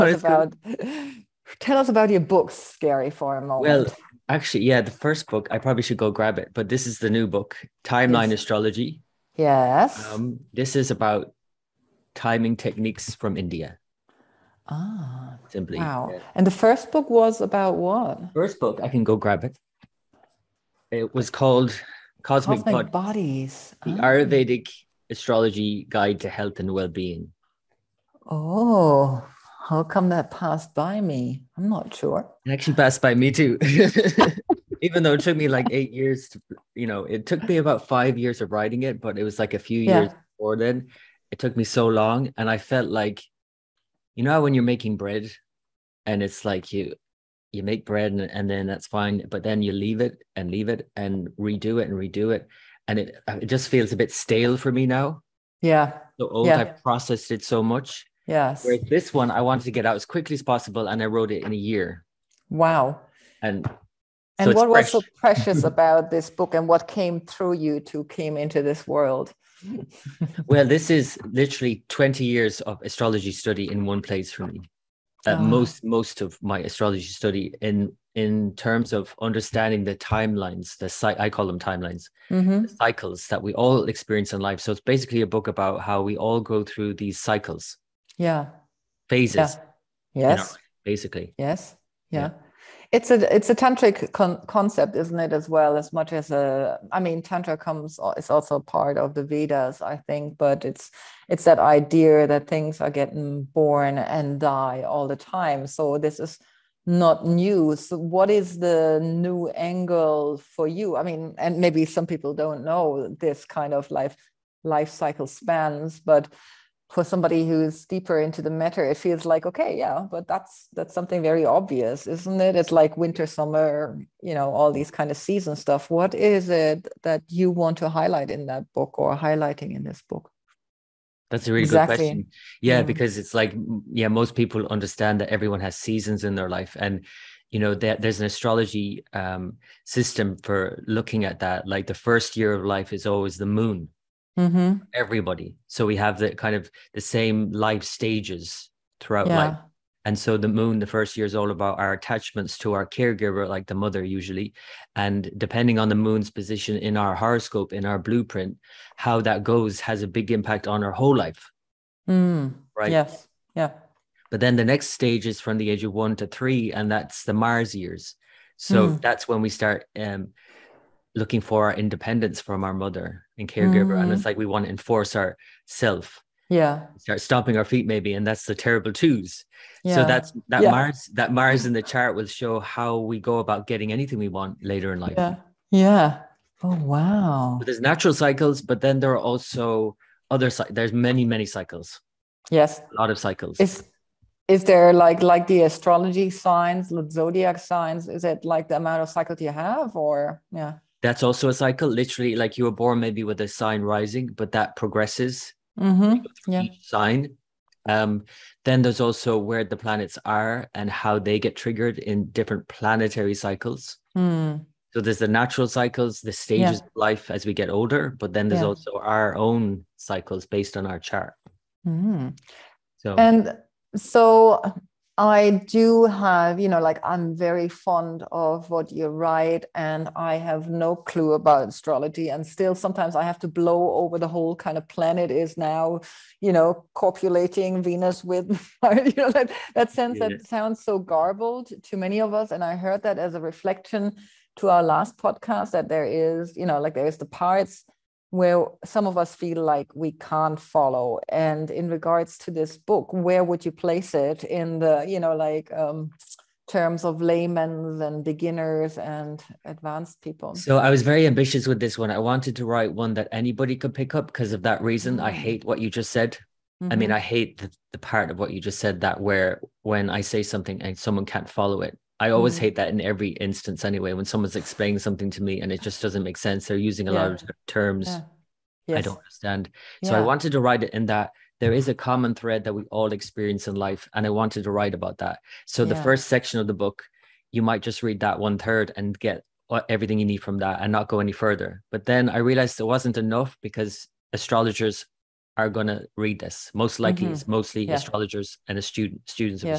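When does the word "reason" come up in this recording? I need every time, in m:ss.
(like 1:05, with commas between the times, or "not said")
4:24.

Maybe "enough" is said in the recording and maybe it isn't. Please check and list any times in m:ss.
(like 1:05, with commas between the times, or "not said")
4:53.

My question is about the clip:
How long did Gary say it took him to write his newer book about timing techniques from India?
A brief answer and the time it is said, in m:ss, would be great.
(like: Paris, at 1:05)
1 year, at 1:01.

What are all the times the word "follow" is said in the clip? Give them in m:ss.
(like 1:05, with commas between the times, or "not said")
4:10, 4:31.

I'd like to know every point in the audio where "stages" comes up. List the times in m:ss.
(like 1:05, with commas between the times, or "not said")
2:27, 2:44, 3:36.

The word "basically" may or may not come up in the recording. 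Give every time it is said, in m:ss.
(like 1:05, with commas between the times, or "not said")
1:24, 1:30.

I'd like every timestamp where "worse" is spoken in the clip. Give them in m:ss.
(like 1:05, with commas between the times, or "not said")
not said.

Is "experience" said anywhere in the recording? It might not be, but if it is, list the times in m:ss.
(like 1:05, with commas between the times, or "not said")
1:23, 4:43.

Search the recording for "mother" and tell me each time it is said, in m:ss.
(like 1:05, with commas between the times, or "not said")
2:33, 2:52.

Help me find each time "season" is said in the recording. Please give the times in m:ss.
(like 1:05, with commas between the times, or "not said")
2:05, 2:15.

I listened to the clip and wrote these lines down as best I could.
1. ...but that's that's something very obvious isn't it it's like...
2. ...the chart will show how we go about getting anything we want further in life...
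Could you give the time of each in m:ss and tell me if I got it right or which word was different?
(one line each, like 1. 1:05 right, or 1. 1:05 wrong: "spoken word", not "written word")
1. 2:00 right
2. 3:01 wrong: "later", not "further".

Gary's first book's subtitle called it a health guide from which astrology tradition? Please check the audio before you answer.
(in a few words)
Ayurvedic.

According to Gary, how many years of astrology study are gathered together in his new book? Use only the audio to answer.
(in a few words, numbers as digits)
20.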